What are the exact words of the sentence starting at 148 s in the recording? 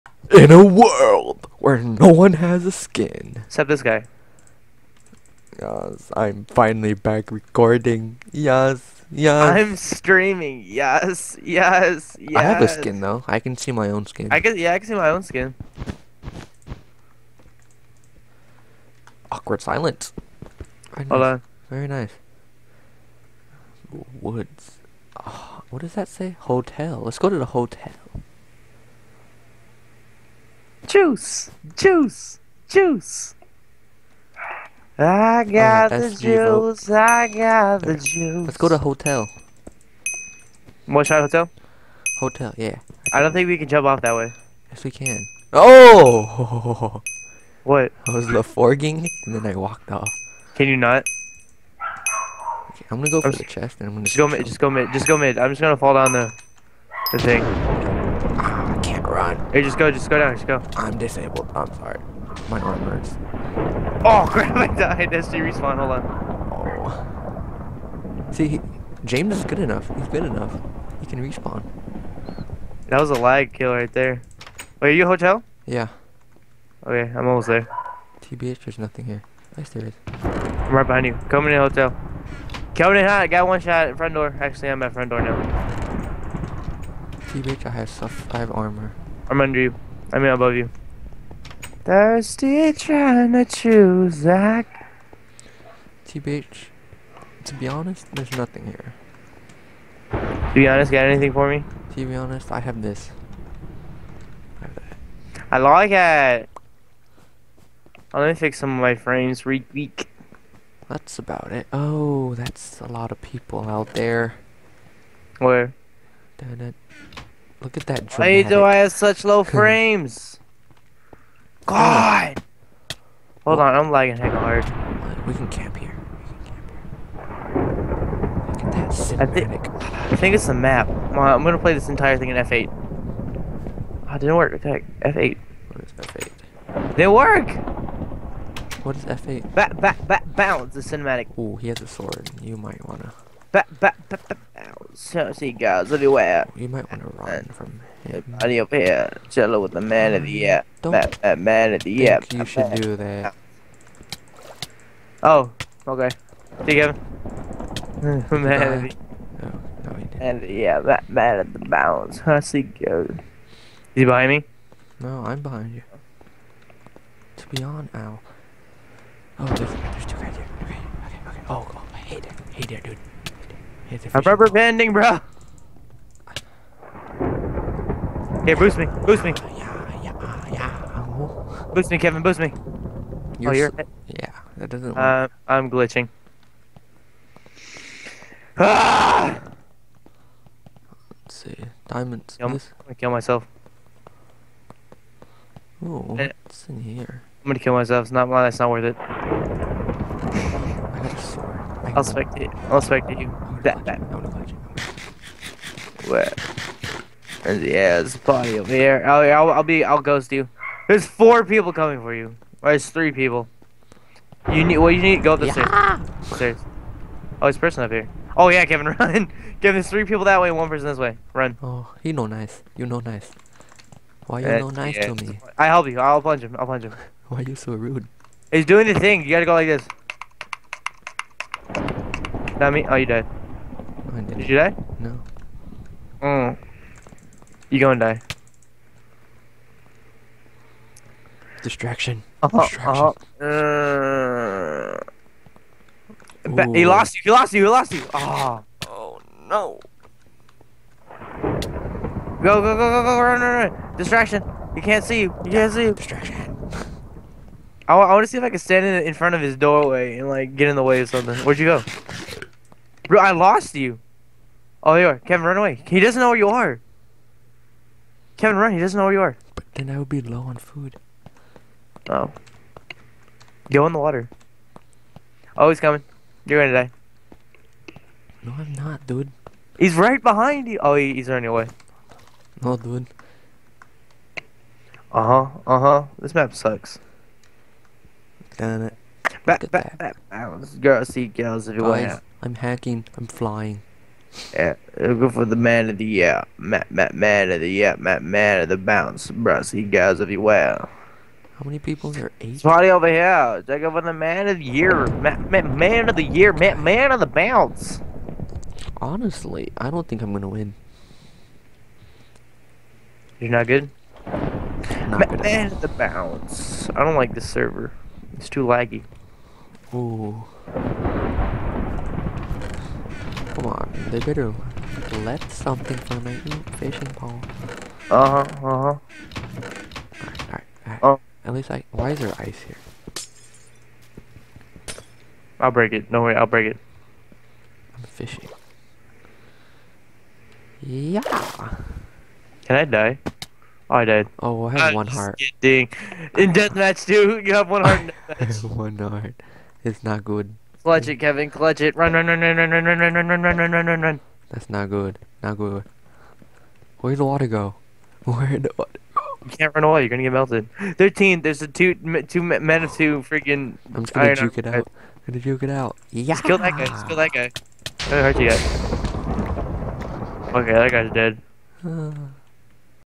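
I up here, chill with the man of the um, year.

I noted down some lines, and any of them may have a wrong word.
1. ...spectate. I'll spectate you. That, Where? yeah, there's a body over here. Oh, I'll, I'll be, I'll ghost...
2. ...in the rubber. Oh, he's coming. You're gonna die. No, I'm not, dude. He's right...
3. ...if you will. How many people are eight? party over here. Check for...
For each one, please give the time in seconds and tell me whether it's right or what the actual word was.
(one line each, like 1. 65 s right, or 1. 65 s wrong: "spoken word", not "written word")
1. 202 s right
2. 273 s wrong: "water", not "rubber"
3. 300 s right.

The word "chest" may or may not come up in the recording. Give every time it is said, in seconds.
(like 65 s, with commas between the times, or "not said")
53 s.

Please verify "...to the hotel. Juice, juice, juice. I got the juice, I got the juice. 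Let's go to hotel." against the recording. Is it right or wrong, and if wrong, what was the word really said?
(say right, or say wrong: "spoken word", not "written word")
right.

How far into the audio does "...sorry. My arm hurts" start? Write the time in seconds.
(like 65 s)
61 s.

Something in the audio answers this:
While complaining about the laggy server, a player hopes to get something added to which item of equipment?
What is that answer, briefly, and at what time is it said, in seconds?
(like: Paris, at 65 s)
Fishing pole, at 326 s.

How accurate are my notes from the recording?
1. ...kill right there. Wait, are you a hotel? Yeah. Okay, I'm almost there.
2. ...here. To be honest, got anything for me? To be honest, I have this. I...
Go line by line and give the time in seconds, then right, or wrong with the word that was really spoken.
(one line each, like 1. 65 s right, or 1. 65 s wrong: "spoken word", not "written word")
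1. 73 s right
2. 98 s right.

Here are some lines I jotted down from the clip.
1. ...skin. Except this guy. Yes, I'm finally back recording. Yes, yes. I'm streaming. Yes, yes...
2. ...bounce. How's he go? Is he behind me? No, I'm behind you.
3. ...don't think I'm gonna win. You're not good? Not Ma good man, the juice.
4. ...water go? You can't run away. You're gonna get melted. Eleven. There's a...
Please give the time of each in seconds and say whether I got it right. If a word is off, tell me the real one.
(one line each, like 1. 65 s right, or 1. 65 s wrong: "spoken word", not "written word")
1. 2 s right
2. 161 s right
3. 309 s wrong: "bounce", not "juice"
4. 358 s wrong: "Thirteen", not "Eleven".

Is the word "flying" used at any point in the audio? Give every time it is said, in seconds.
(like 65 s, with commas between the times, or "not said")
293 s.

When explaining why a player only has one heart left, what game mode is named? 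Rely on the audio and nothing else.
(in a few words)
Deathmatch.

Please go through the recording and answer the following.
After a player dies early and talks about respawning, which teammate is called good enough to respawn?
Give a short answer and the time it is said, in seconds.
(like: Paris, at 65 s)
James, at 69 s.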